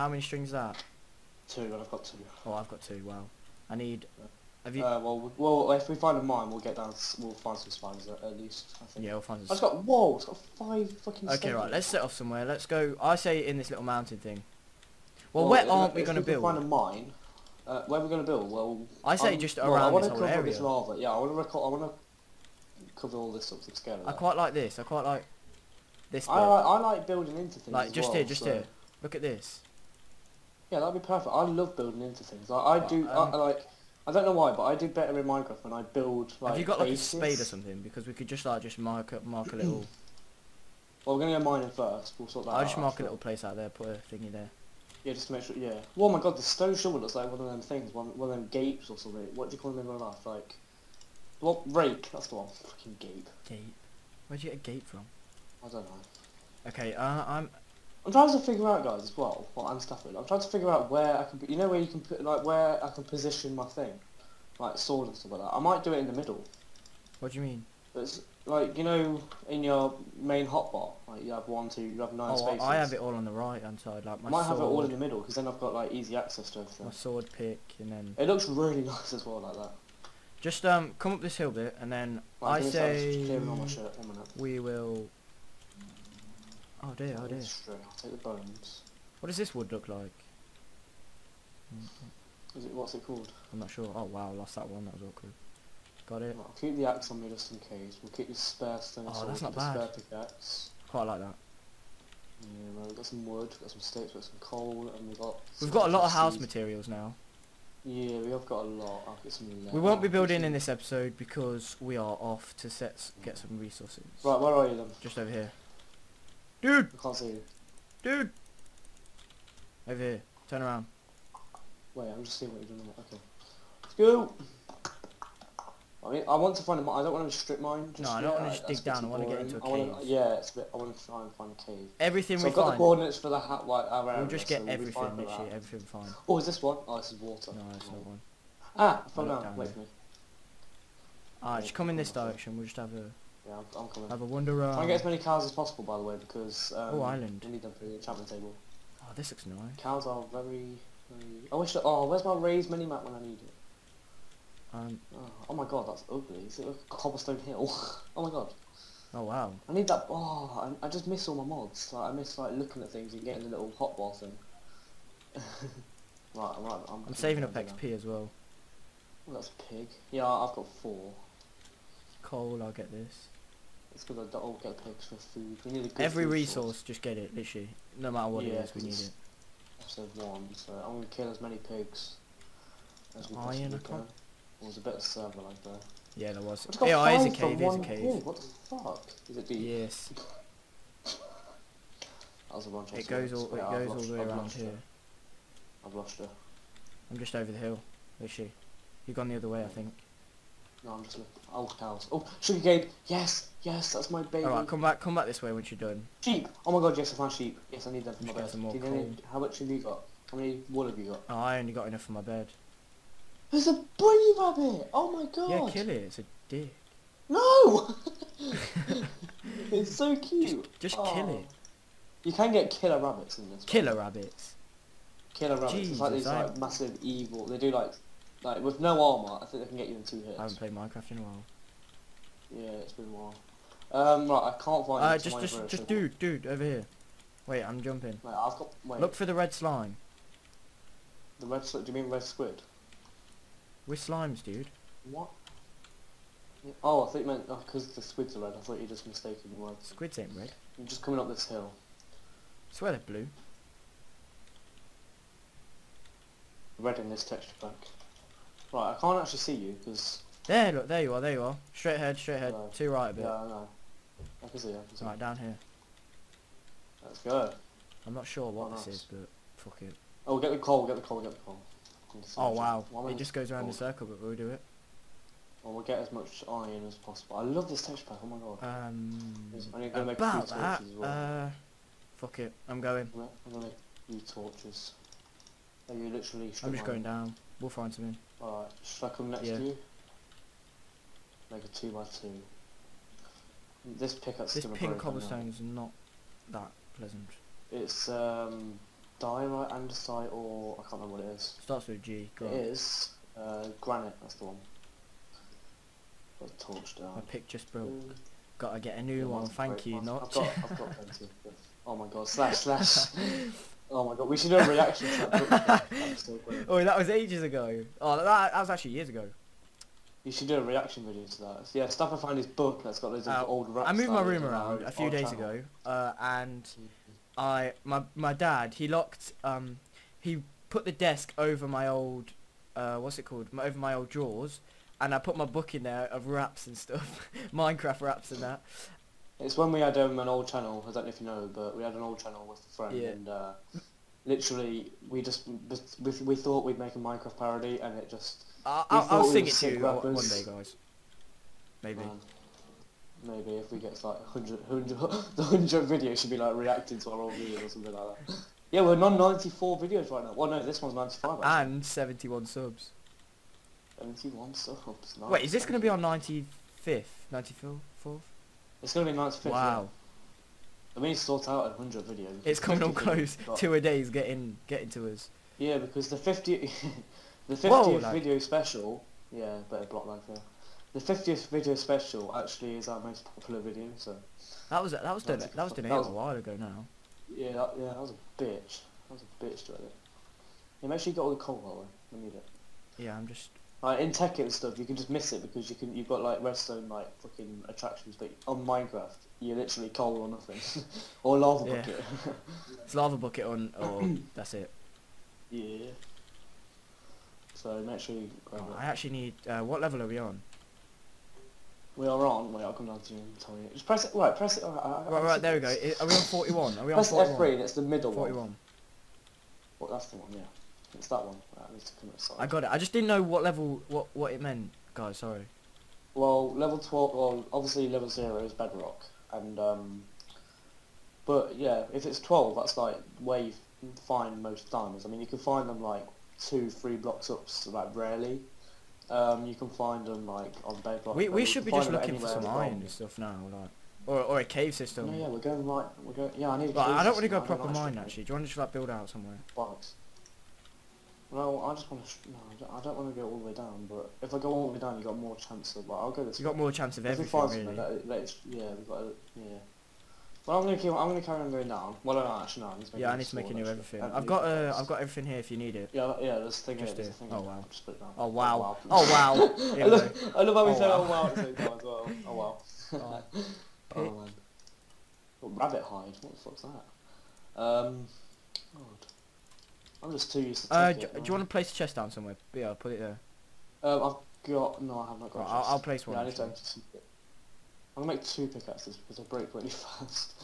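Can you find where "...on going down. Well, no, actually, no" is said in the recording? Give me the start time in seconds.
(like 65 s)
461 s.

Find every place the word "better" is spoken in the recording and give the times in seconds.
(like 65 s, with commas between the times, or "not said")
34 s, 184 s, 379 s.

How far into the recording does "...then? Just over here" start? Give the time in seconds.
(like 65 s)
114 s.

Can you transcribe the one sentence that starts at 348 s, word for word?
I'll, I'll sing it to you rappers.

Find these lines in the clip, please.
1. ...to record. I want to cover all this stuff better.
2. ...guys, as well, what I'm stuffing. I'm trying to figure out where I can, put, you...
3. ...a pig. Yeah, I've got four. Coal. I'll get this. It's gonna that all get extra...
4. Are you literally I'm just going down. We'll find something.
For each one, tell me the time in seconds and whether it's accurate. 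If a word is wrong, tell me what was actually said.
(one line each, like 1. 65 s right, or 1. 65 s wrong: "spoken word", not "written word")
1. 21 s wrong: "together", not "better"
2. 58 s right
3. 169 s right
4. 285 s right.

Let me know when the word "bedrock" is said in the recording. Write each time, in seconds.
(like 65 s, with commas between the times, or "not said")
428 s, 440 s.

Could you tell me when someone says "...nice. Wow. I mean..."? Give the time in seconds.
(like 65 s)
369 s.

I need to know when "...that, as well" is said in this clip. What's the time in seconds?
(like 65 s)
280 s.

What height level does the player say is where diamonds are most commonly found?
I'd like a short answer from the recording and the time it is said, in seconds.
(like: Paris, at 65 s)
12, at 426 s.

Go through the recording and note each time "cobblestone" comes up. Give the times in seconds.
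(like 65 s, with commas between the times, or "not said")
156 s, 294 s.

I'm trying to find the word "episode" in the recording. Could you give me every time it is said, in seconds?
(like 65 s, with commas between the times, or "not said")
110 s, 179 s.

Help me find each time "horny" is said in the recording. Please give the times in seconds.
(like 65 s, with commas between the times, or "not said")
not said.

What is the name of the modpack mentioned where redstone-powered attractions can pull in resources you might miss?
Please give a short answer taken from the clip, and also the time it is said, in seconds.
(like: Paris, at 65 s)
Tekkit, at 394 s.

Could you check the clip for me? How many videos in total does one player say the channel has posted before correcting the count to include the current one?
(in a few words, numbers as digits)
94.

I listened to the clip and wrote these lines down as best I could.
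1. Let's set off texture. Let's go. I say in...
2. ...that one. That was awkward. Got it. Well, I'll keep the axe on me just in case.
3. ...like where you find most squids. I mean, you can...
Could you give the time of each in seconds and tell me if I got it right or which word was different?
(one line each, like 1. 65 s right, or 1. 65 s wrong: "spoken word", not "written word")
1. 11 s wrong: "somewhere", not "texture"
2. 94 s right
3. 432 s wrong: "diamonds", not "squids".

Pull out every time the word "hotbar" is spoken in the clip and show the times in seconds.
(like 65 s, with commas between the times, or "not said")
70 s, 163 s.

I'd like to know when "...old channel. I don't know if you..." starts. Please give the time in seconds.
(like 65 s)
340 s.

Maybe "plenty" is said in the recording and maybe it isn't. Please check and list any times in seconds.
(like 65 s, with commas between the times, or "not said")
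310 s.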